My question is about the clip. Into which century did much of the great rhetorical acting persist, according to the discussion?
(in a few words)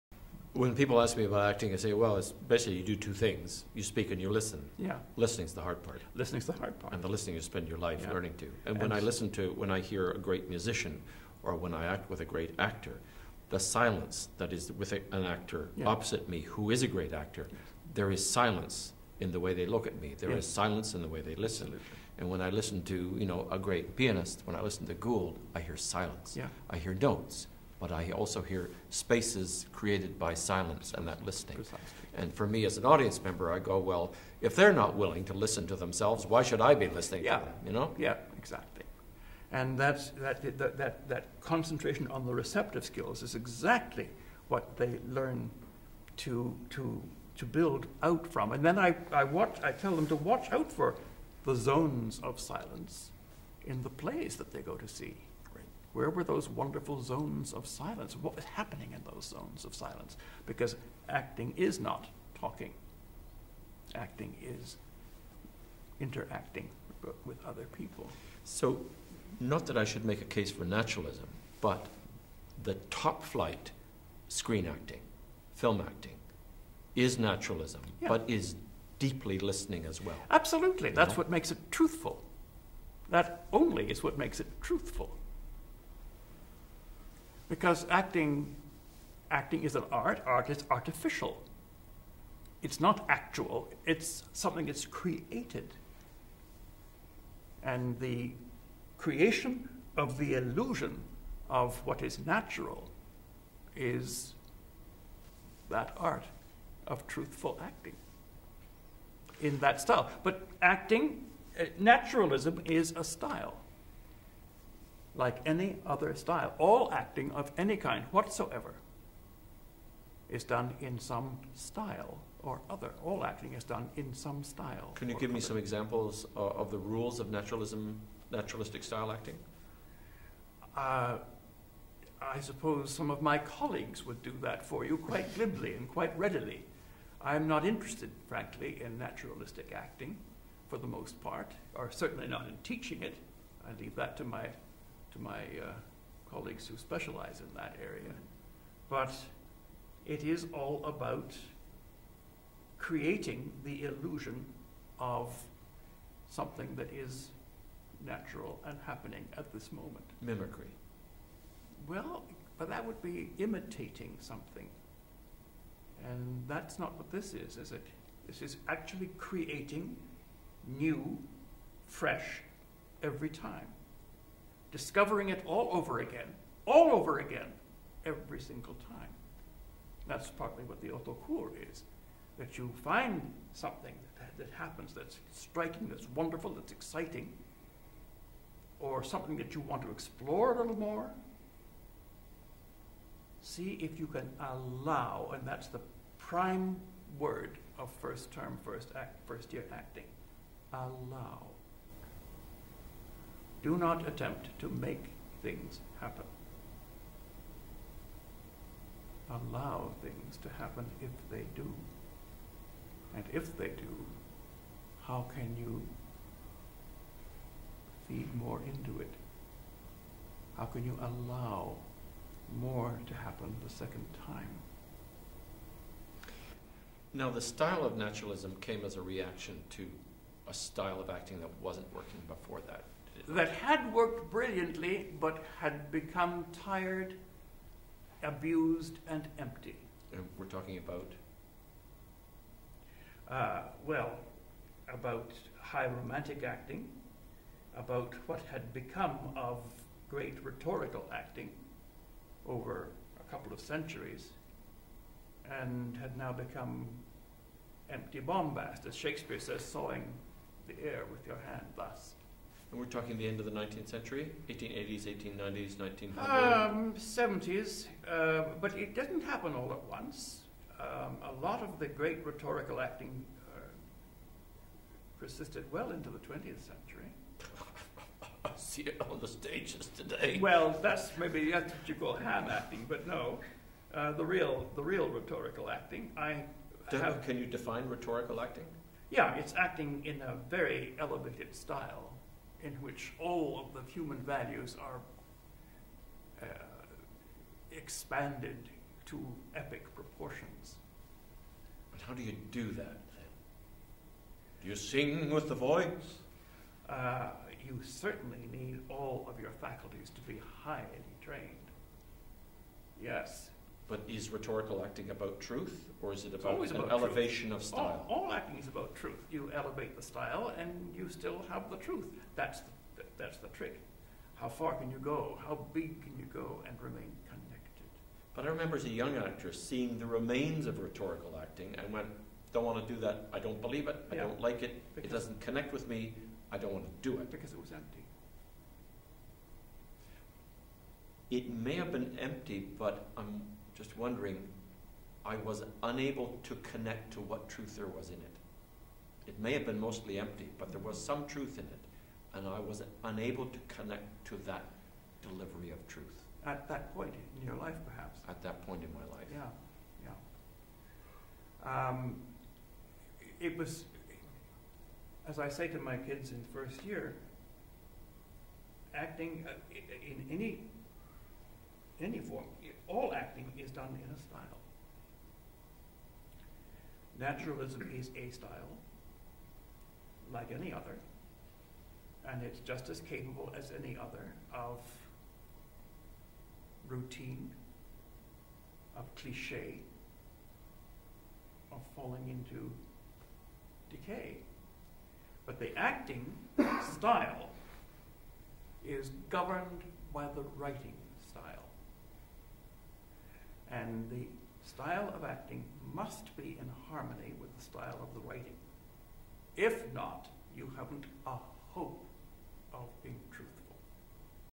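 20th century.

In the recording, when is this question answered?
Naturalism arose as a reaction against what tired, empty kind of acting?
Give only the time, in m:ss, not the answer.
4:05.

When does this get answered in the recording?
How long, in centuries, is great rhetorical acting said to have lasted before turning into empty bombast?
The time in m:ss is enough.
4:13.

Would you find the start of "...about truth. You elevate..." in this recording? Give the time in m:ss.
5:18.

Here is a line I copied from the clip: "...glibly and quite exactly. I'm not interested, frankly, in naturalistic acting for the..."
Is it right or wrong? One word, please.
wrong.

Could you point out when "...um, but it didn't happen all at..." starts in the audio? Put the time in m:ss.
4:28.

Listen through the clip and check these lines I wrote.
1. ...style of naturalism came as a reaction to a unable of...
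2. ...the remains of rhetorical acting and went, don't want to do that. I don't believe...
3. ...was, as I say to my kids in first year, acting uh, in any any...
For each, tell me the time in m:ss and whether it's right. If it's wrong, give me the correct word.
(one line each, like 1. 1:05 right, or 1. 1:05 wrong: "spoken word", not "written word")
1. 3:47 wrong: "style", not "unable"
2. 5:29 right
3. 6:03 right.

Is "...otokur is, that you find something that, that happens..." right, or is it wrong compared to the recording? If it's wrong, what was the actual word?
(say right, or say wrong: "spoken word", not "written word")
right.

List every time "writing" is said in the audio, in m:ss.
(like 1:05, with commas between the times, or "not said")
6:40, 6:48.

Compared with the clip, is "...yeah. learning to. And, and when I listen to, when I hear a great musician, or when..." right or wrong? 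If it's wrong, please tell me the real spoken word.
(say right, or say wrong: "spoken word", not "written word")
right.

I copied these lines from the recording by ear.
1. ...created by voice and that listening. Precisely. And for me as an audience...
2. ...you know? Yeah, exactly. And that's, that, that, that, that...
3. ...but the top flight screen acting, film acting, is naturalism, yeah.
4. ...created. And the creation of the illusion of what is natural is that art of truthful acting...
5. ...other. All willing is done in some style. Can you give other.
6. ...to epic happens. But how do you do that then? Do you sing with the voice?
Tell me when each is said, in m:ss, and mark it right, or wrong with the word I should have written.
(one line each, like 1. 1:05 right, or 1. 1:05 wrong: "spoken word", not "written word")
1. 0:29 wrong: "silence", not "voice"
2. 0:37 right
3. 1:11 right
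4. 1:34 right
5. 2:02 wrong: "acting", not "willing"
6. 4:59 wrong: "proportions", not "happens".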